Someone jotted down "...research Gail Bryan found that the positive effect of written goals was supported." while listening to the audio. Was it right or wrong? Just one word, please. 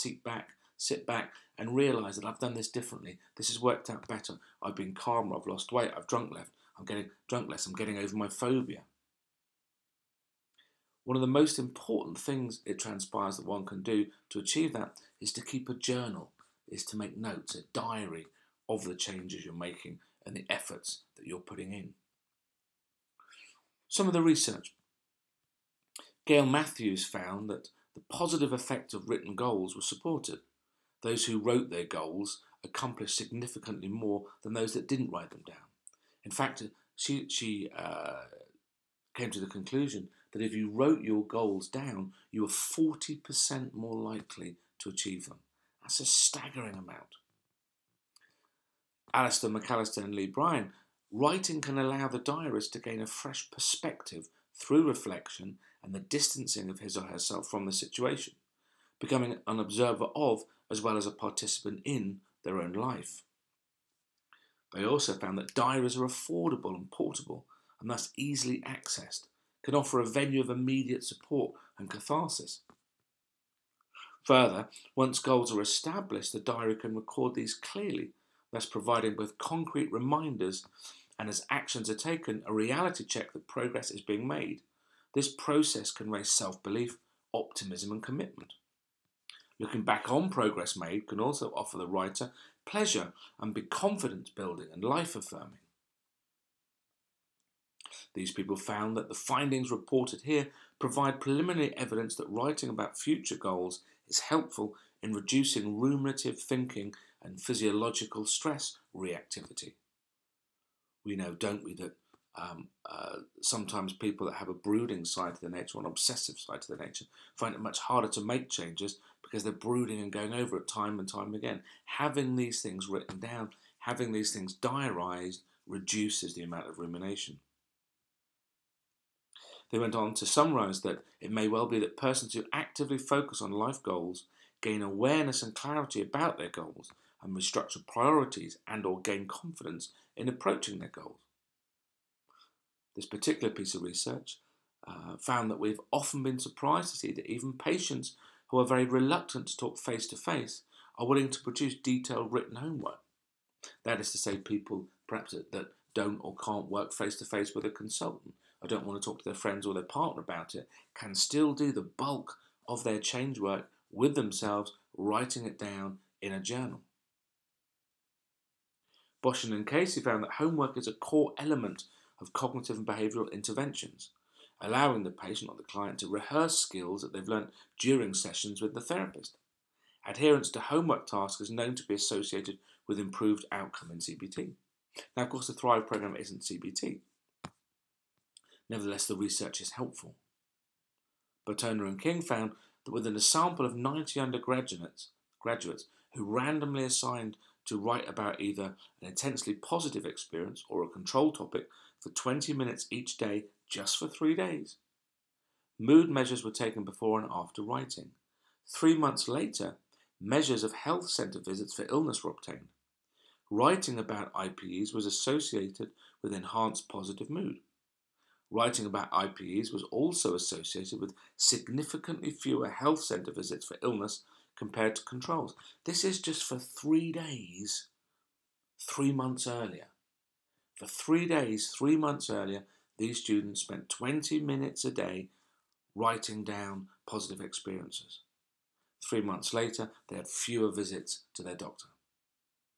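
wrong.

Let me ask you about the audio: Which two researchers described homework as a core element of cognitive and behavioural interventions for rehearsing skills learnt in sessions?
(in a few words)
Boschen and Casey.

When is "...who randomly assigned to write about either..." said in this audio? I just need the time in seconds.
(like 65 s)
196 s.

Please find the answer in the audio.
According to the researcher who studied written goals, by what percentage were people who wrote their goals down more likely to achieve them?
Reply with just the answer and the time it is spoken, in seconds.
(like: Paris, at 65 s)
40%, at 42 s.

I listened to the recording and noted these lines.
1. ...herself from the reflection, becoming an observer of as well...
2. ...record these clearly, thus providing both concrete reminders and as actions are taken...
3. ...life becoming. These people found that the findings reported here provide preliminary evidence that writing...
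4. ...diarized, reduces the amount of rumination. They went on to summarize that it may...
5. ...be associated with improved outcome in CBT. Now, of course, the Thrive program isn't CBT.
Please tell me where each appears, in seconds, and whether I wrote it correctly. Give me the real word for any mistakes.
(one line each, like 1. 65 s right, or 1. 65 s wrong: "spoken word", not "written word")
1. 57 s wrong: "situation", not "reflection"
2. 76 s right
3. 94 s wrong: "affirming", not "becoming"
4. 124 s right
5. 181 s right.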